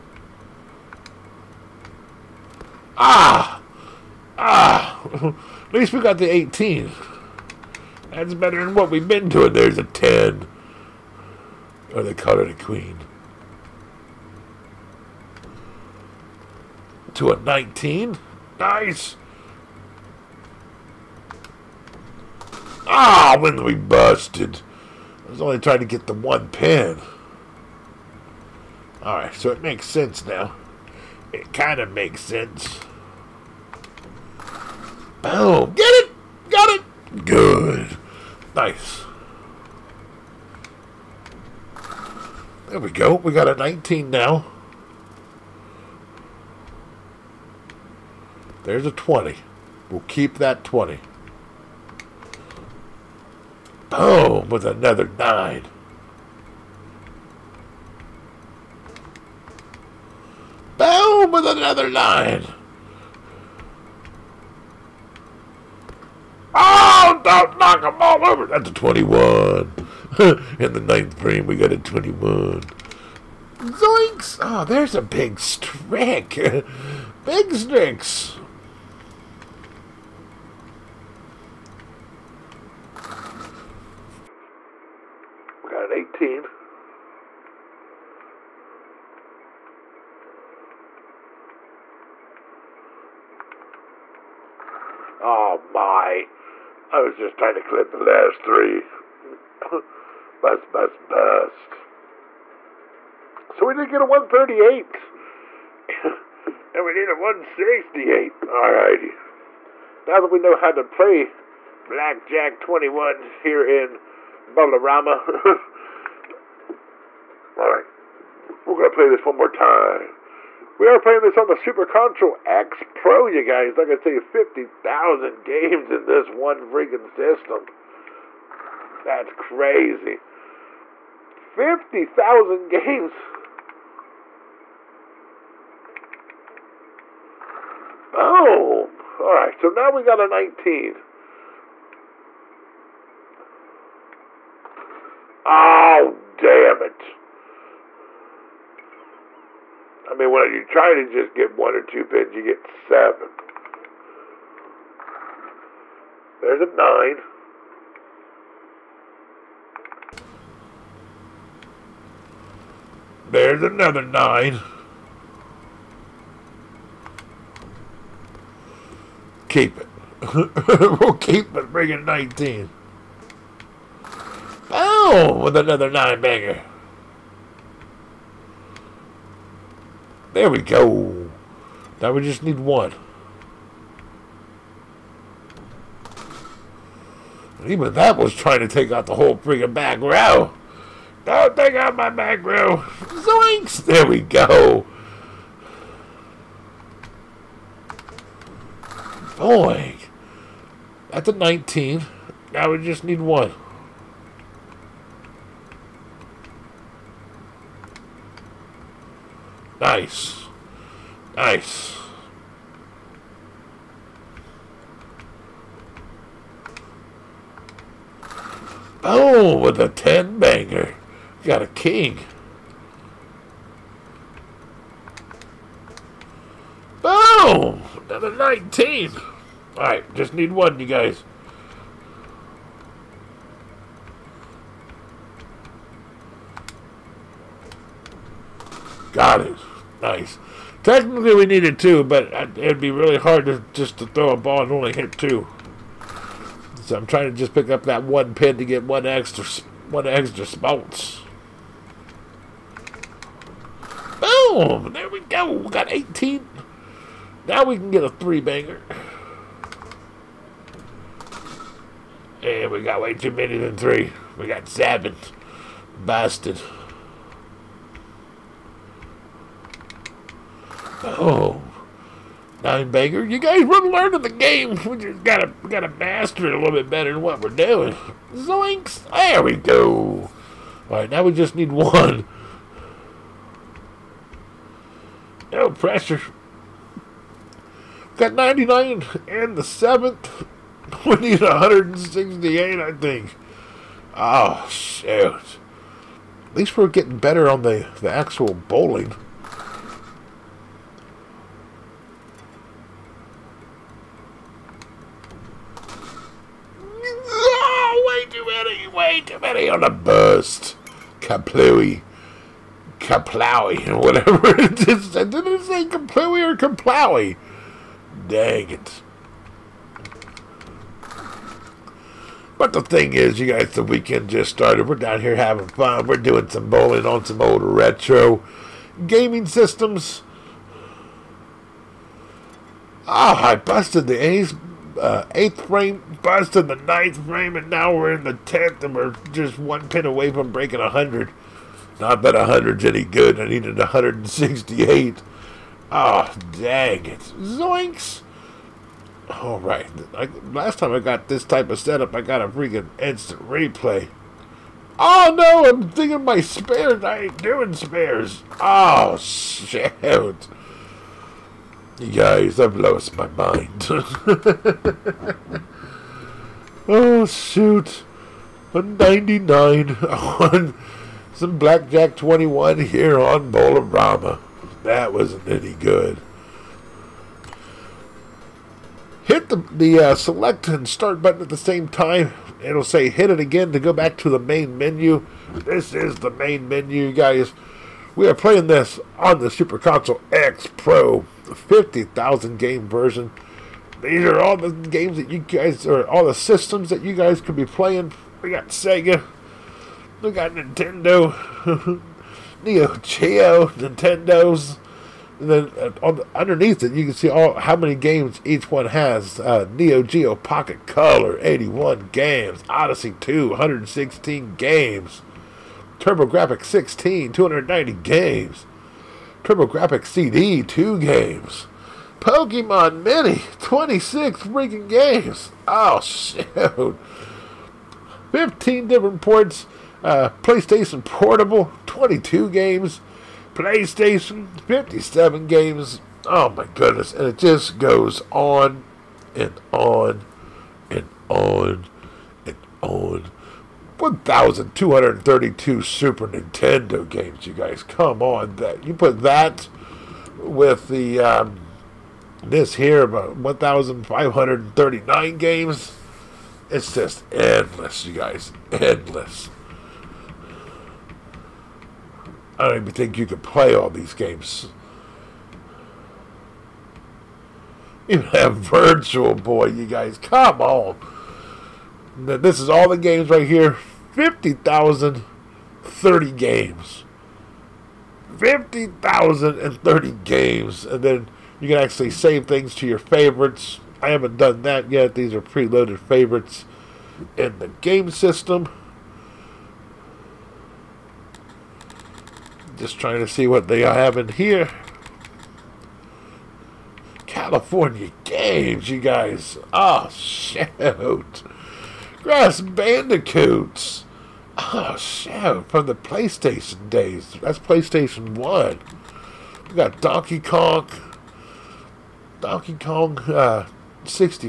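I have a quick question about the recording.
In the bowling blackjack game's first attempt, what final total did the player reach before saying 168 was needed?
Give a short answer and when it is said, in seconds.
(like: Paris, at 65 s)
138, at 104 s.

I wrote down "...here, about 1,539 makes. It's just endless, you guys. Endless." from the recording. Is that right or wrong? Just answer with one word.
wrong.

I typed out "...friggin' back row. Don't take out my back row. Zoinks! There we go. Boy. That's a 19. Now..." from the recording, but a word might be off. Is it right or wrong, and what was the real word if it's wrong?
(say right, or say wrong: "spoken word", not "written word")
right.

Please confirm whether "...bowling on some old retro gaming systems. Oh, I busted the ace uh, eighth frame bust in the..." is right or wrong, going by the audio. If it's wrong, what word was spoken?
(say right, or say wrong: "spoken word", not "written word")
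right.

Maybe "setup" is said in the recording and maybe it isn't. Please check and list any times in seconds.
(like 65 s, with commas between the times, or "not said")
351 s.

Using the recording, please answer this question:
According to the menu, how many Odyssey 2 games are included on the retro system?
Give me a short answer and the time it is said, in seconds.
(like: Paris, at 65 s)
116, at 413 s.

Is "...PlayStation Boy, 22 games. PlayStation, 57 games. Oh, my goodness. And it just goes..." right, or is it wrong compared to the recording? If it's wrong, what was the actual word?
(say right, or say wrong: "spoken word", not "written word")
wrong: "Portable", not "Boy".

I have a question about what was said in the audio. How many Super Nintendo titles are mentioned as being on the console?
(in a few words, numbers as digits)
1,232.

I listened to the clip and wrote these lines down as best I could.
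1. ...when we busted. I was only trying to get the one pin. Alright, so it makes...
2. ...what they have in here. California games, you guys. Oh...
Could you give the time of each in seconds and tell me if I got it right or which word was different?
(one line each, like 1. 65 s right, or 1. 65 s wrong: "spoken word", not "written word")
1. 23 s right
2. 493 s right.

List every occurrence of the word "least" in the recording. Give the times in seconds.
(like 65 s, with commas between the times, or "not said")
5 s, 296 s.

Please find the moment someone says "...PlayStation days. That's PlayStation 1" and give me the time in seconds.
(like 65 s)
505 s.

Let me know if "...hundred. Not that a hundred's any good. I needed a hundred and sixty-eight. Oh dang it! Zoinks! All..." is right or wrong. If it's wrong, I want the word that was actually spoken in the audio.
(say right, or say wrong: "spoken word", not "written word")
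right.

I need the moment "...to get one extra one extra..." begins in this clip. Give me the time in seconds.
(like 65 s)
248 s.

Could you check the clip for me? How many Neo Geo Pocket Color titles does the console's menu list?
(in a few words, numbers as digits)
81.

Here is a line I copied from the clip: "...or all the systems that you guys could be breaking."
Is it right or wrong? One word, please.
wrong.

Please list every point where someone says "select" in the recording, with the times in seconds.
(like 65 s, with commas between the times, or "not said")
380 s.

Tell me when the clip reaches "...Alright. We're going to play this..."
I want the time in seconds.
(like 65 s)
117 s.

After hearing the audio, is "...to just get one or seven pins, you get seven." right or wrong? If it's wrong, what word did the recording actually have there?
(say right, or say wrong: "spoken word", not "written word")
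wrong: "two", not "seven".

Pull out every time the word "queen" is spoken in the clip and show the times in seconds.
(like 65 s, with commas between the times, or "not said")
12 s.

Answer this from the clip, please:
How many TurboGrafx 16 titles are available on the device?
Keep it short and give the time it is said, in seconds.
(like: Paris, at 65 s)
290, at 417 s.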